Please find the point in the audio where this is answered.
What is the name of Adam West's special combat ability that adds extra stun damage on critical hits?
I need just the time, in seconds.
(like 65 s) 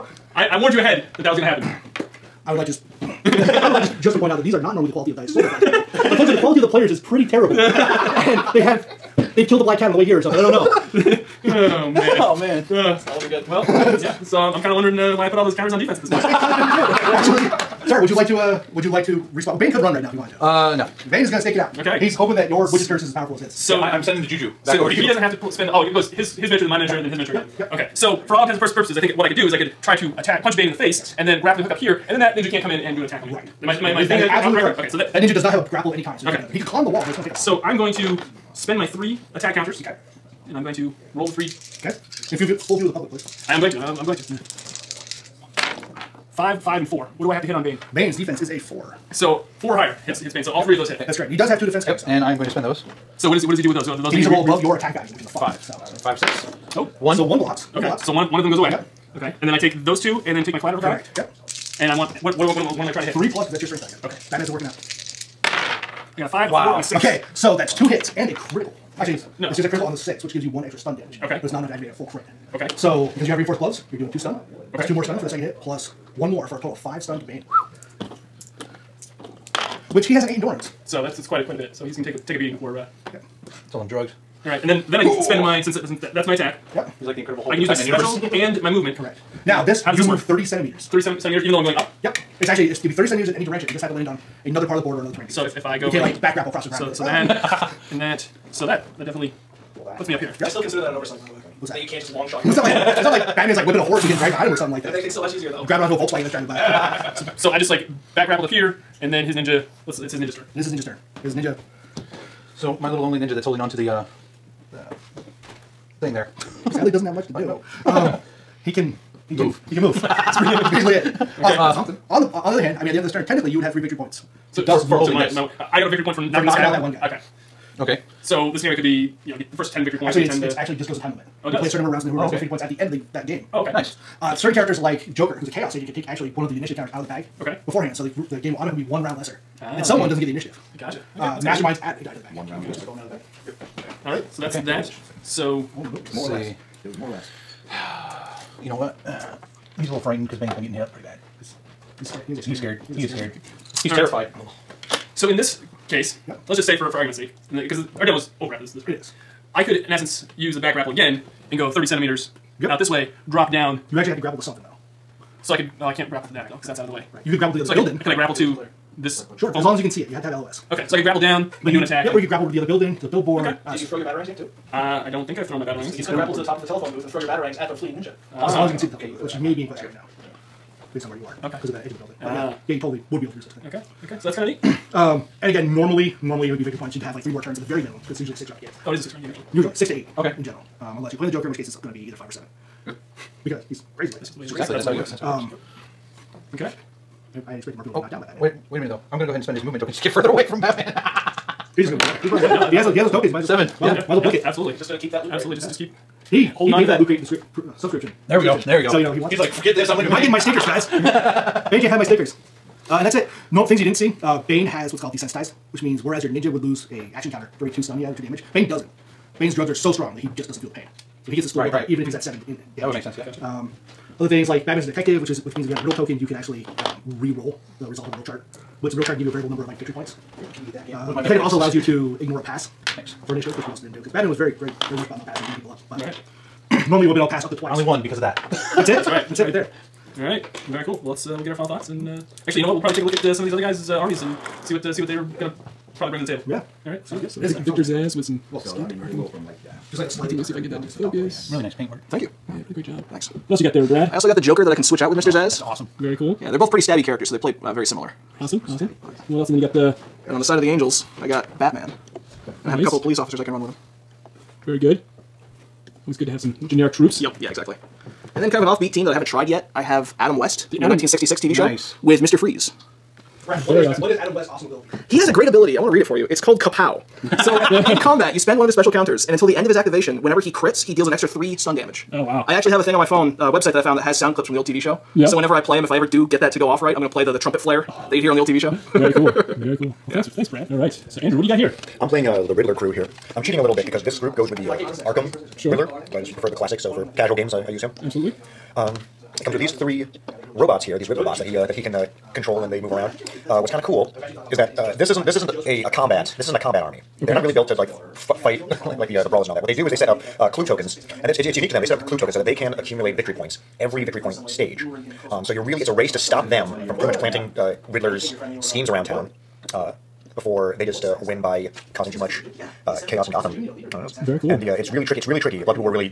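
276 s.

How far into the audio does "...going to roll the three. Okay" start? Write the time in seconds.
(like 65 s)
40 s.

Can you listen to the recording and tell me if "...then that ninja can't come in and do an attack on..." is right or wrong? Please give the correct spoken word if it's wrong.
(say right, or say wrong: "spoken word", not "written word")
right.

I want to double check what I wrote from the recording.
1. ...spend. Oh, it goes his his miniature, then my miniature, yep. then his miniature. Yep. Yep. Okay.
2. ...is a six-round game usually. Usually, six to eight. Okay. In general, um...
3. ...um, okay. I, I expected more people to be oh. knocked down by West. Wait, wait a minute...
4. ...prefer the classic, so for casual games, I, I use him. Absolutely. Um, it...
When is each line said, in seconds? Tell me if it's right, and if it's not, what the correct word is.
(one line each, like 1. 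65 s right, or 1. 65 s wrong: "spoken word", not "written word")
1. 25 s right
2. 188 s right
3. 195 s wrong: "Batman", not "West"
4. 296 s right.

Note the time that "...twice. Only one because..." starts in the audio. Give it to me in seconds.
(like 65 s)
237 s.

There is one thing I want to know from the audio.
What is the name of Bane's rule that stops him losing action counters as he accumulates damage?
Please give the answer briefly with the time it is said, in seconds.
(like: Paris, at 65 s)
Desensitized, at 215 s.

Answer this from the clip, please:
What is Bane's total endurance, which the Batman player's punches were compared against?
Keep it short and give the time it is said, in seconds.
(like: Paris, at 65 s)
8, at 80 s.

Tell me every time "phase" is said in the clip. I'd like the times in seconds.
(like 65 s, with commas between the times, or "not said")
not said.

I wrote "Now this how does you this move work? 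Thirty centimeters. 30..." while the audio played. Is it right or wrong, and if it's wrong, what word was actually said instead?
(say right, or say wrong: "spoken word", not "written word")
right.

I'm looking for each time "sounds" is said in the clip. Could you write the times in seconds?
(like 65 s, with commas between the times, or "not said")
247 s, 284 s.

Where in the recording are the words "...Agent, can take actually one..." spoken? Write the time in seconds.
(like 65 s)
135 s.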